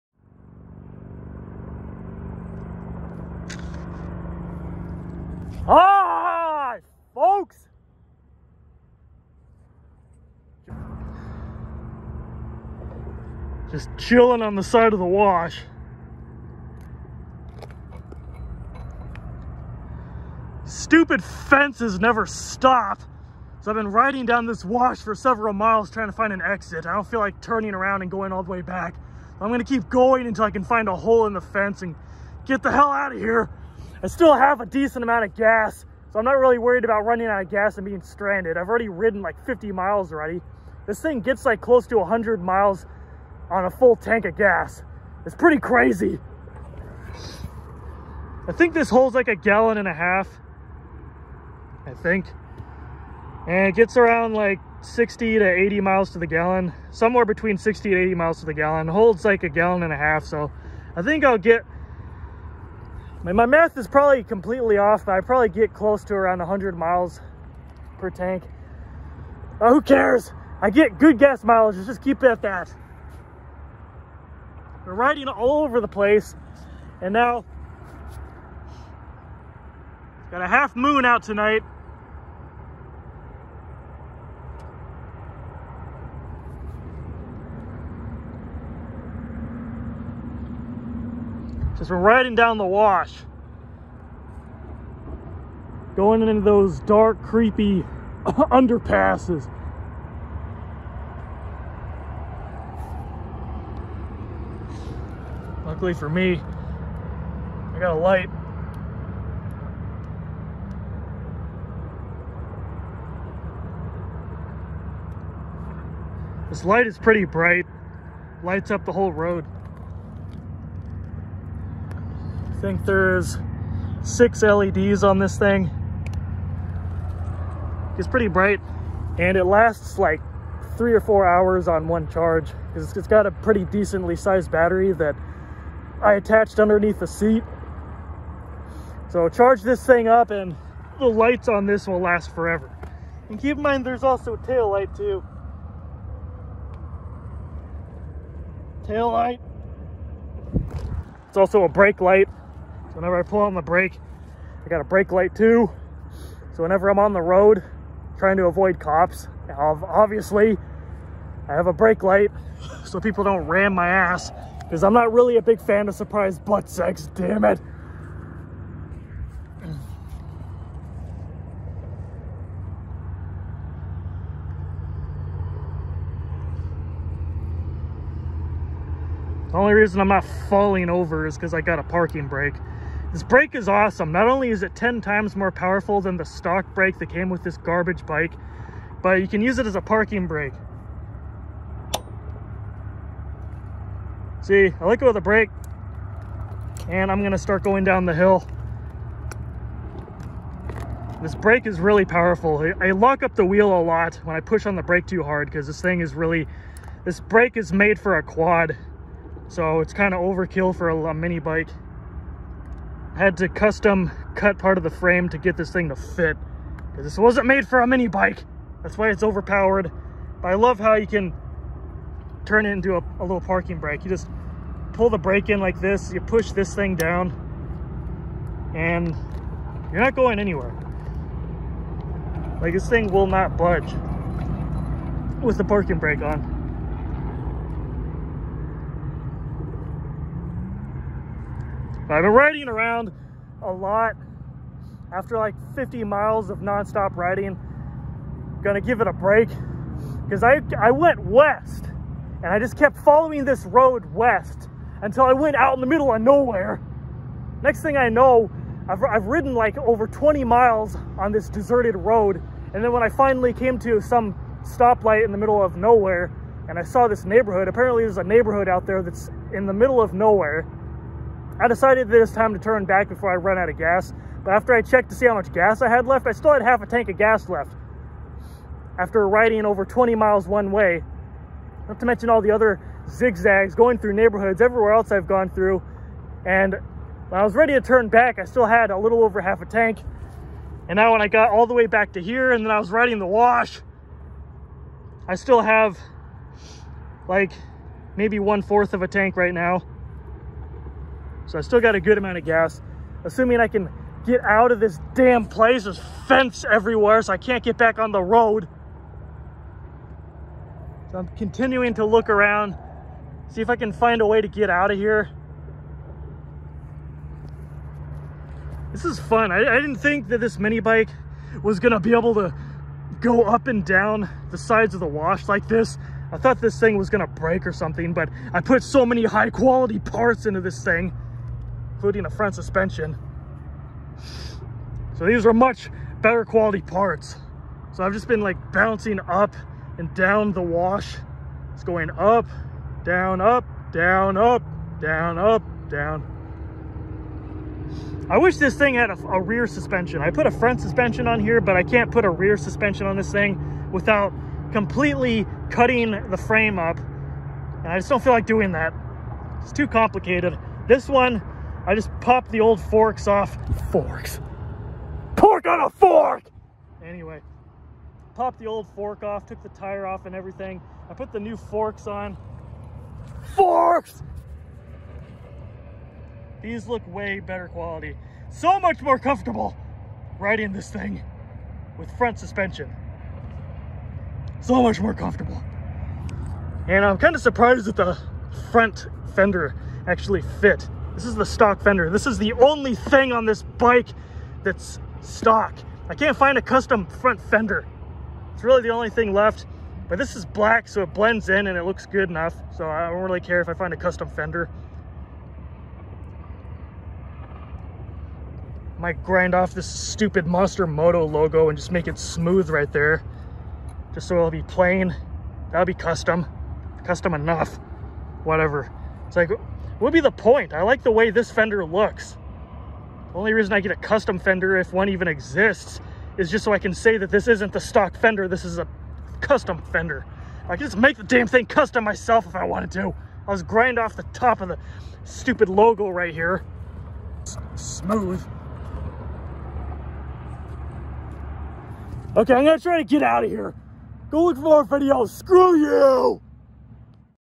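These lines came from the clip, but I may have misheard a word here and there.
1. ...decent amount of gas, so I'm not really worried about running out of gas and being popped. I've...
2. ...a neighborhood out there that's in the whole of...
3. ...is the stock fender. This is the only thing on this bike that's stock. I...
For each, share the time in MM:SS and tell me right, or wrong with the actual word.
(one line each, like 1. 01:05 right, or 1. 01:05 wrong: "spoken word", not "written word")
1. 00:34 wrong: "stranded", not "popped"
2. 04:28 wrong: "middle", not "whole"
3. 06:31 right.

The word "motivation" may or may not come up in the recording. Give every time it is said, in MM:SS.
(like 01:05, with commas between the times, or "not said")
not said.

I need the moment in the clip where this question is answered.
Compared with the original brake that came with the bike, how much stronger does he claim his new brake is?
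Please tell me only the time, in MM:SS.
03:04.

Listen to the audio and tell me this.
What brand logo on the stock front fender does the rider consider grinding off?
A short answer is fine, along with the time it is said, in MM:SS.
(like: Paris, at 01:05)
Monster Moto, at 06:50.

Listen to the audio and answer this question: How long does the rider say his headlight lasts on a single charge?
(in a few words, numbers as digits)
3 or 4 hours.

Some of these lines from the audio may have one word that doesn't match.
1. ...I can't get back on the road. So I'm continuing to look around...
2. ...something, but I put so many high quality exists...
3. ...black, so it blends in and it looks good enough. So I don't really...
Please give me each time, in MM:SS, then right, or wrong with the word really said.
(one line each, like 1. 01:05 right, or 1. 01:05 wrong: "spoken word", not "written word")
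1. 05:07 right
2. 05:27 wrong: "parts", not "exists"
3. 06:40 right.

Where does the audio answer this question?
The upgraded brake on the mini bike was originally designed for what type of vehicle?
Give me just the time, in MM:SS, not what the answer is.
03:28.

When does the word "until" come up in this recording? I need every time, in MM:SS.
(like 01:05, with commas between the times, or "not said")
00:30, 04:15.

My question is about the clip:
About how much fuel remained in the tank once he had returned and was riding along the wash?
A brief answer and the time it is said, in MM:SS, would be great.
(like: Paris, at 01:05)
One fourth of a tank, at 04:58.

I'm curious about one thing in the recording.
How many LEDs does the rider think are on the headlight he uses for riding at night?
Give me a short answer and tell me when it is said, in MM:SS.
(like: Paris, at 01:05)
6, at 02:04.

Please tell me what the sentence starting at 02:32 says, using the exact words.
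So whenever I pull on the brake, I got a brake light too.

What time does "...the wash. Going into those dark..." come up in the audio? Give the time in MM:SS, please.
01:32.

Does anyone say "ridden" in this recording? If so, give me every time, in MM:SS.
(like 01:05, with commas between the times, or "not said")
00:38, 04:19.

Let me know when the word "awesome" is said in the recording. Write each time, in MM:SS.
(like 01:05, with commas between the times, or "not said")
03:03.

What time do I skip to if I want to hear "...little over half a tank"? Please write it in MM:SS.
04:48.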